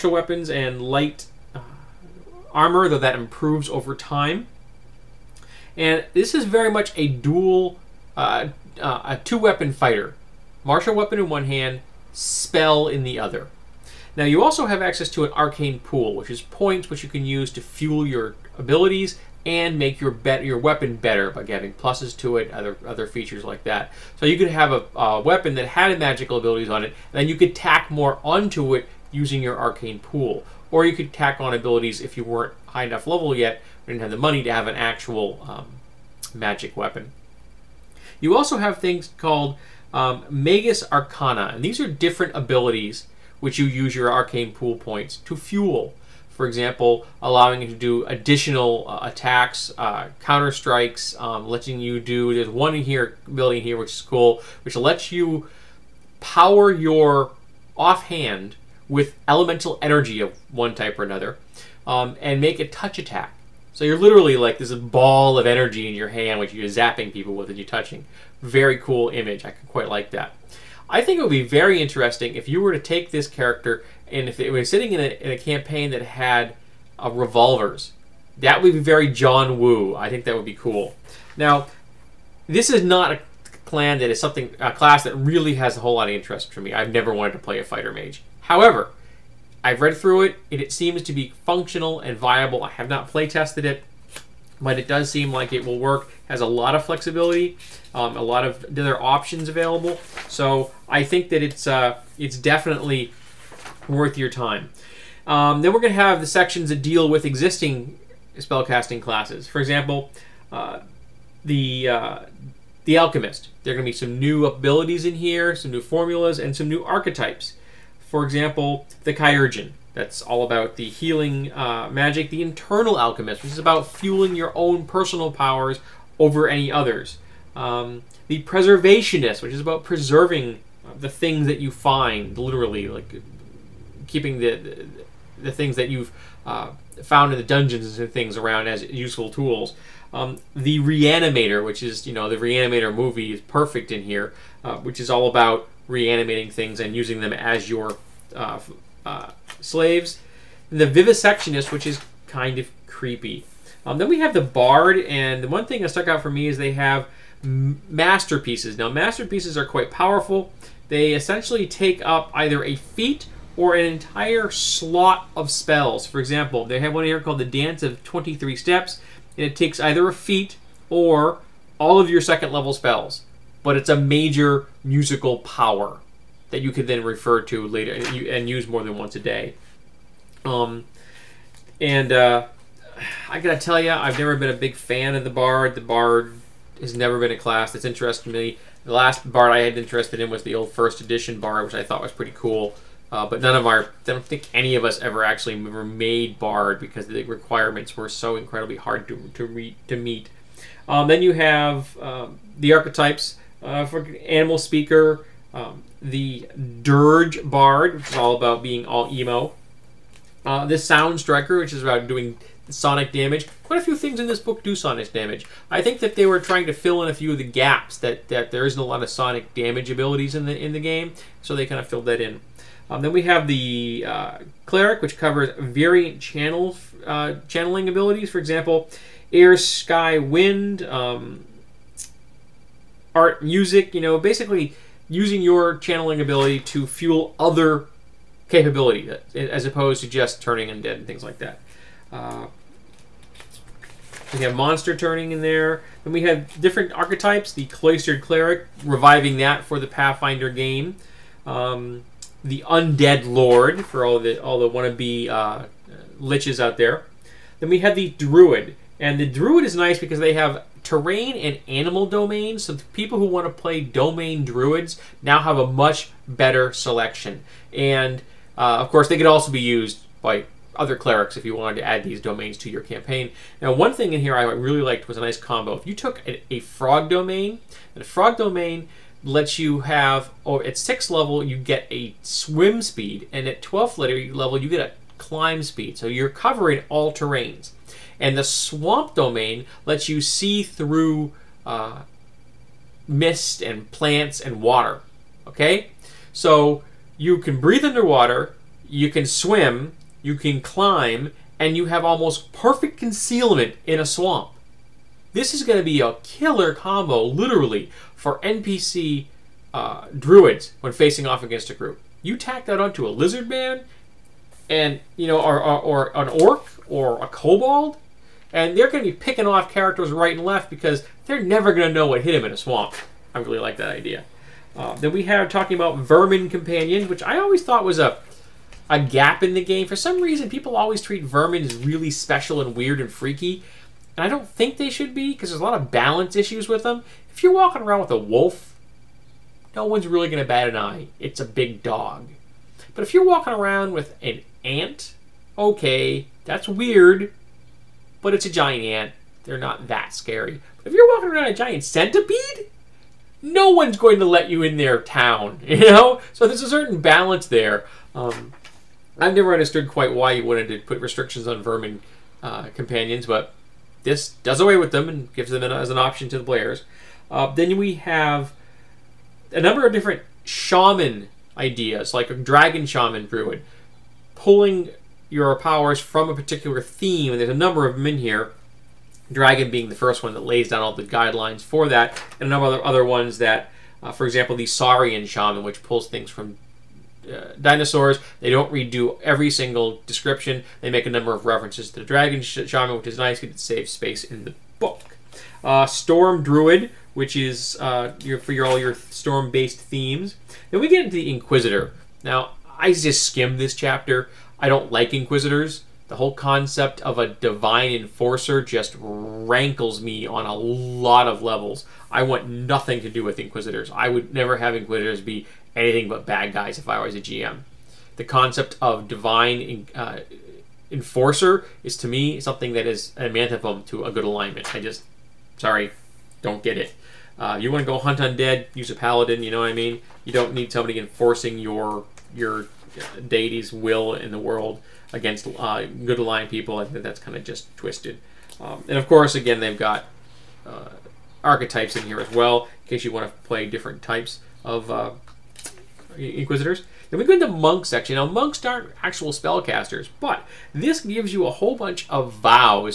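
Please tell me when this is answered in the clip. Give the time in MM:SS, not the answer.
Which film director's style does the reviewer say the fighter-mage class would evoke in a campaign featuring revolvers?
01:19.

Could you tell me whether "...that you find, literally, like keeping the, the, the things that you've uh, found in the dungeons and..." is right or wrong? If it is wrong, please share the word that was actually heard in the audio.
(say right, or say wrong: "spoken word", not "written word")
right.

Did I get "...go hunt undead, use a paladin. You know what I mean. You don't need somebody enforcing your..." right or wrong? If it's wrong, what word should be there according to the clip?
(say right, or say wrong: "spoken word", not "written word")
right.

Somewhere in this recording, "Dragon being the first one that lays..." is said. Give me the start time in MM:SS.
06:19.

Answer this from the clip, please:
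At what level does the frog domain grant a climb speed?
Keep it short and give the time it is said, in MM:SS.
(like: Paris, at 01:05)
12th, at 04:43.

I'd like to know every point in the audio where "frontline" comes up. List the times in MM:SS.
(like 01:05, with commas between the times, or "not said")
not said.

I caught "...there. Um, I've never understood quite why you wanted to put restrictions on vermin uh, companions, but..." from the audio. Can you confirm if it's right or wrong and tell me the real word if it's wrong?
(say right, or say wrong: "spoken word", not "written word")
right.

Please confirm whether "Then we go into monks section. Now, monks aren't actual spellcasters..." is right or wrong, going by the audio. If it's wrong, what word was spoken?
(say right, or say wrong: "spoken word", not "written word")
right.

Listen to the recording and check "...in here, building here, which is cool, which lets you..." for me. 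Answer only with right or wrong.
right.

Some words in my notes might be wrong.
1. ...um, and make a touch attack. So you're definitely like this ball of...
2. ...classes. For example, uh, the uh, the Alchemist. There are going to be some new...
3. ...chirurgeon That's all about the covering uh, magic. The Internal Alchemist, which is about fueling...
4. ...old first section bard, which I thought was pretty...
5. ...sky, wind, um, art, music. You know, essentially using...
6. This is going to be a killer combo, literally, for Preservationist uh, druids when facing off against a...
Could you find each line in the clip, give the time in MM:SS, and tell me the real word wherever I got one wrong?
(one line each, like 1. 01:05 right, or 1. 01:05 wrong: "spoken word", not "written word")
1. 01:01 wrong: "literally", not "definitely"
2. 01:49 right
3. 01:59 wrong: "healing", not "covering"
4. 03:10 wrong: "edition", not "section"
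5. 03:49 wrong: "basically", not "essentially"
6. 05:05 wrong: "NPC", not "Preservationist".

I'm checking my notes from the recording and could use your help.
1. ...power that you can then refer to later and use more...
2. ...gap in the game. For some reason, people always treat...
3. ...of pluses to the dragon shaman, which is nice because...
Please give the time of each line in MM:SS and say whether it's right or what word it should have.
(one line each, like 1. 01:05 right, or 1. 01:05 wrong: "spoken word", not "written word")
1. 02:55 right
2. 05:28 right
3. 06:31 wrong: "references", not "pluses".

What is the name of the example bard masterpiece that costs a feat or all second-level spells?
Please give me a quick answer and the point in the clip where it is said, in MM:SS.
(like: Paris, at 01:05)
Dance of 23 Steps, at 02:47.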